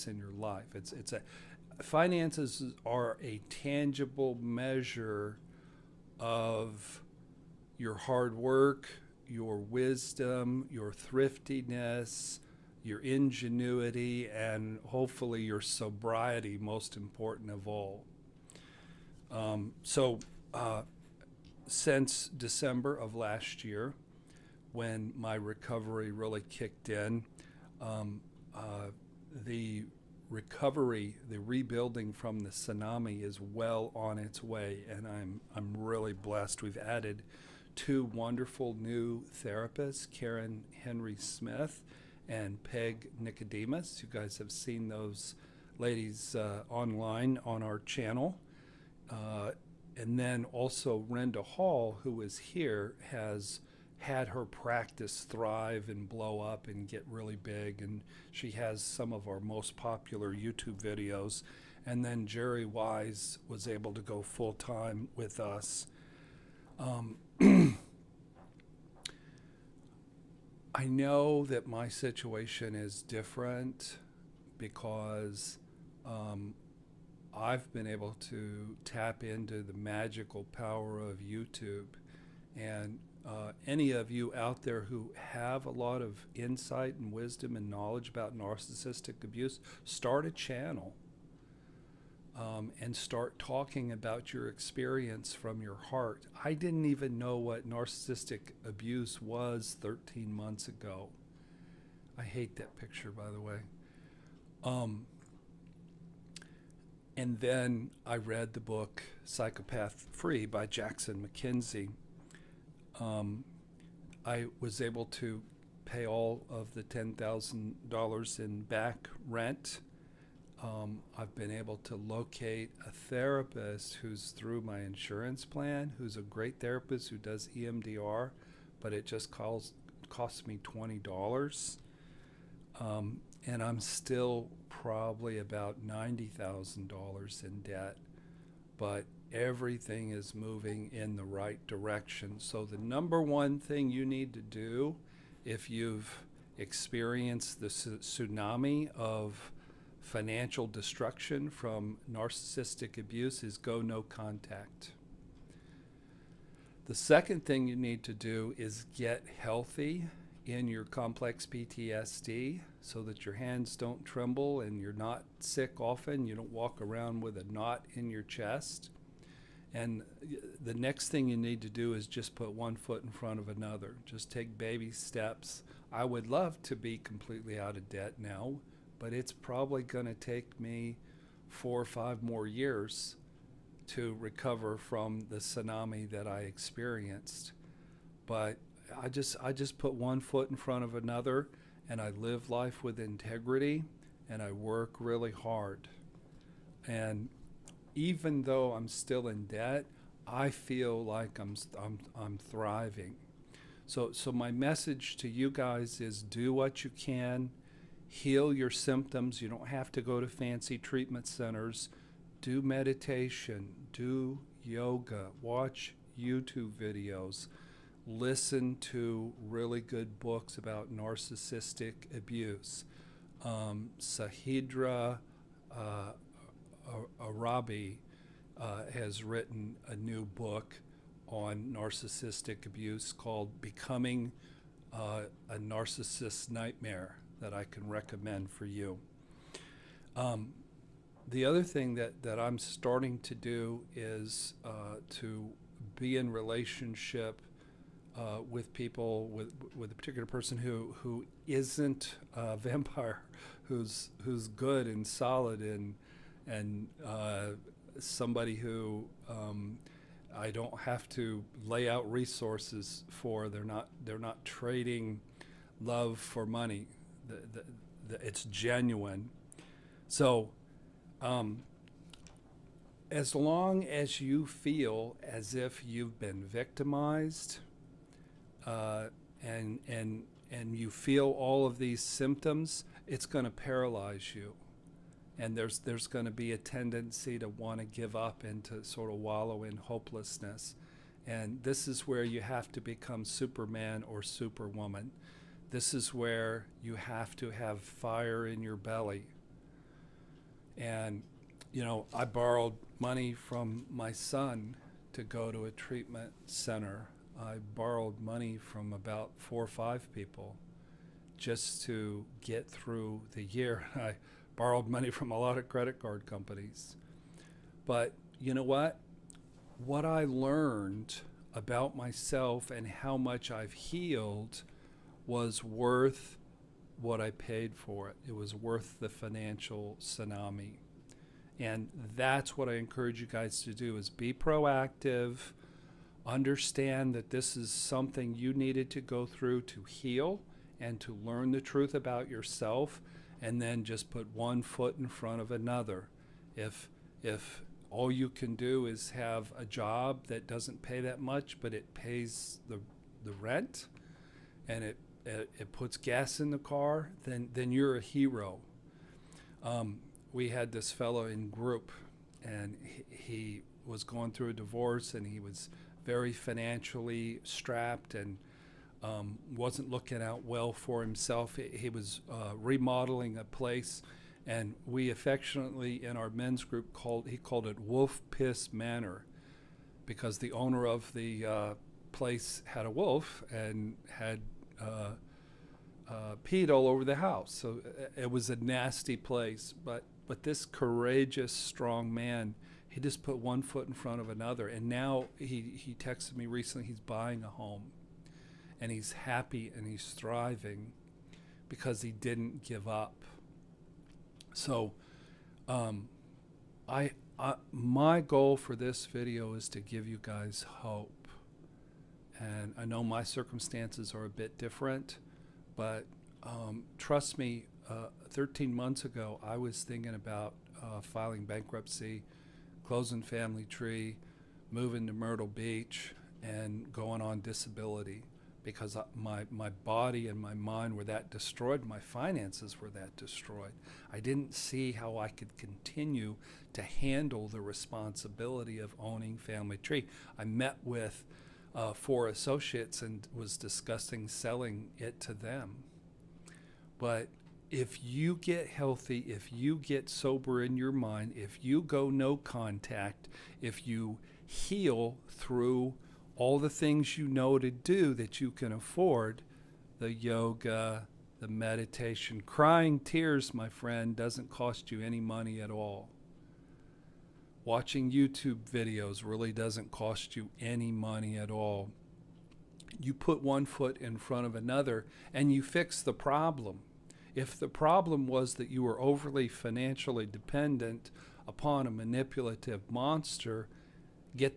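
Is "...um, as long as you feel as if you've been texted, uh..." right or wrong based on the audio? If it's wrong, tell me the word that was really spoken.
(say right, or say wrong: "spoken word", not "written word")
wrong: "victimized", not "texted".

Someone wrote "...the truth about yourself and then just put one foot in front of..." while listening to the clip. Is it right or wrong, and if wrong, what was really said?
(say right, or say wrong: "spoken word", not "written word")
right.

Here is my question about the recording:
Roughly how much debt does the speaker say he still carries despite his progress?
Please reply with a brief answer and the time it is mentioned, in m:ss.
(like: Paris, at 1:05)
$90,000, at 2:15.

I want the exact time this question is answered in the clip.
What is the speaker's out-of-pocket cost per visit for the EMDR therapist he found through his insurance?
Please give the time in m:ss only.
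2:10.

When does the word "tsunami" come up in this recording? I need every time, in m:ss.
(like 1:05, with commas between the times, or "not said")
0:32, 2:27, 3:05, 5:29.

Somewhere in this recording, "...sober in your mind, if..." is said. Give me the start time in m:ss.
7:30.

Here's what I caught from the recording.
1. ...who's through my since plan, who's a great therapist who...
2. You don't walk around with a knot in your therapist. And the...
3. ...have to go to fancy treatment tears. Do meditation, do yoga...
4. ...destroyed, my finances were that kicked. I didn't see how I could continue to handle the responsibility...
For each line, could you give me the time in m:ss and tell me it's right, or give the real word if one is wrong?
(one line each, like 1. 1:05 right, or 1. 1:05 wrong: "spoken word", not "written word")
1. 2:03 wrong: "insurance", not "since"
2. 2:46 wrong: "chest", not "therapist"
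3. 3:29 wrong: "centers", not "tears"
4. 7:11 wrong: "destroyed", not "kicked".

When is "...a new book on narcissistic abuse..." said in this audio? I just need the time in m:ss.
3:49.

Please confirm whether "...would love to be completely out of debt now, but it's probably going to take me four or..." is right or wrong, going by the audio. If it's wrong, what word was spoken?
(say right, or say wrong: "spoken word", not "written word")
right.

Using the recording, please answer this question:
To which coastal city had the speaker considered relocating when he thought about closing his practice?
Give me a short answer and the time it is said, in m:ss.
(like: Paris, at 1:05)
Myrtle Beach, at 7:05.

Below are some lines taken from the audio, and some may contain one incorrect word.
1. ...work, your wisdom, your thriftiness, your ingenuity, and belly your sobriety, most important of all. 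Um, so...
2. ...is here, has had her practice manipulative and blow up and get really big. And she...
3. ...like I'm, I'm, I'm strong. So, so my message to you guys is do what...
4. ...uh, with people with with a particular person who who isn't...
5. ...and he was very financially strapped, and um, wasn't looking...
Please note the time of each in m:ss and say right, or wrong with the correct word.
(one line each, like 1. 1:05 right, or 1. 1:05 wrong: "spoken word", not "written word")
1. 0:08 wrong: "hopefully", not "belly"
2. 0:52 wrong: "thrive", not "manipulative"
3. 3:21 wrong: "thriving", not "strong"
4. 4:08 right
5. 6:05 right.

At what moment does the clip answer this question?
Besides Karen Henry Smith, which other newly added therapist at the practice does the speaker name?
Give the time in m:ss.
0:42.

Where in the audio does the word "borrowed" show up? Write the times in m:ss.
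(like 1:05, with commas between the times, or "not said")
5:02, 5:07, 5:14.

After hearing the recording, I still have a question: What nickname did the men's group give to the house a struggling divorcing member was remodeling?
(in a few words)
Wolf Piss Manor.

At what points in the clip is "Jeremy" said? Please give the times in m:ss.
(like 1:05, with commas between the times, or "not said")
not said.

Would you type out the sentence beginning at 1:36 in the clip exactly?
I didn't even know what narcissistic abuse was 13 months ago.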